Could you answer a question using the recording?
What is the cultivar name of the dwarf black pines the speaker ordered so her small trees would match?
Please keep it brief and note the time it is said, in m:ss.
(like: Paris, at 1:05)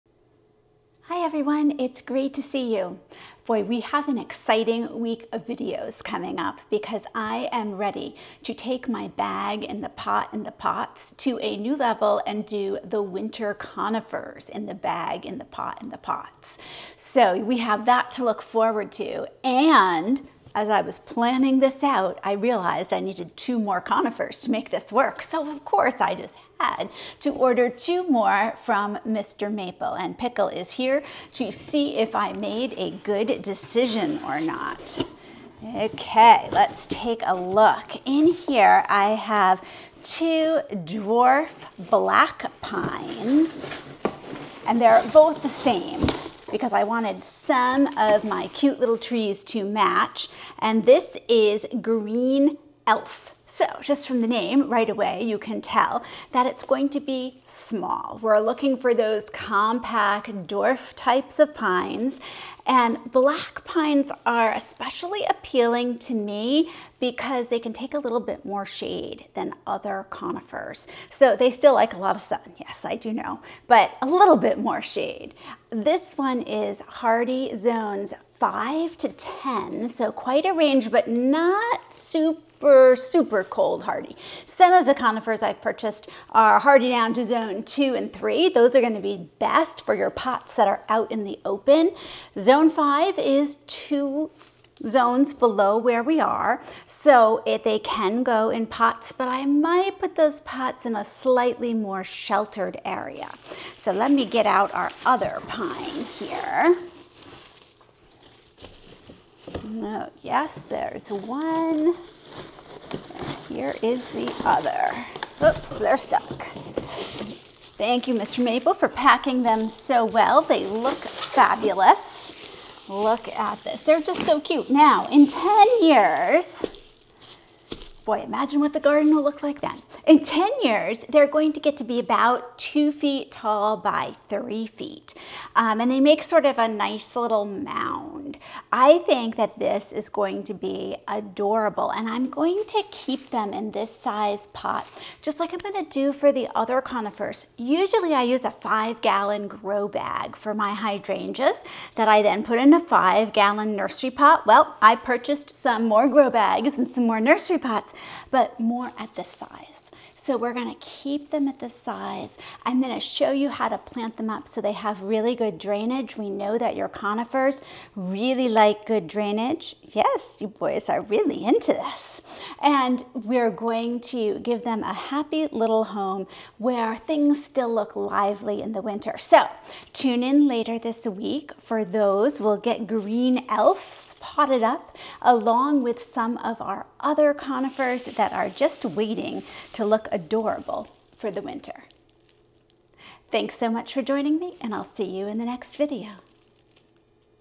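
Green Elf, at 0:51.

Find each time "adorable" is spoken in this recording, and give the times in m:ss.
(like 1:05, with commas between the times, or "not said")
2:21, 3:10.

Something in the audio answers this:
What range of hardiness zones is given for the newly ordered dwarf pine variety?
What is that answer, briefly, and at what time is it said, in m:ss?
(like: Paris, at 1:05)
5 to 10, at 1:17.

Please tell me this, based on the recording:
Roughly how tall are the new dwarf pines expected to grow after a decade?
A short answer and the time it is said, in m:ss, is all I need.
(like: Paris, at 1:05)
2 feet, at 2:12.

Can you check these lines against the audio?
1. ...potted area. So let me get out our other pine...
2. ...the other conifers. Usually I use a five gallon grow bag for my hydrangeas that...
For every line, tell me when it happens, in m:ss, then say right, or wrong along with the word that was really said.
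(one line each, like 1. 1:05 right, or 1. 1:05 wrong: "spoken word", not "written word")
1. 1:42 wrong: "sheltered", not "potted"
2. 2:26 right.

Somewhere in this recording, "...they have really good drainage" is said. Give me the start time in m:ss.
2:44.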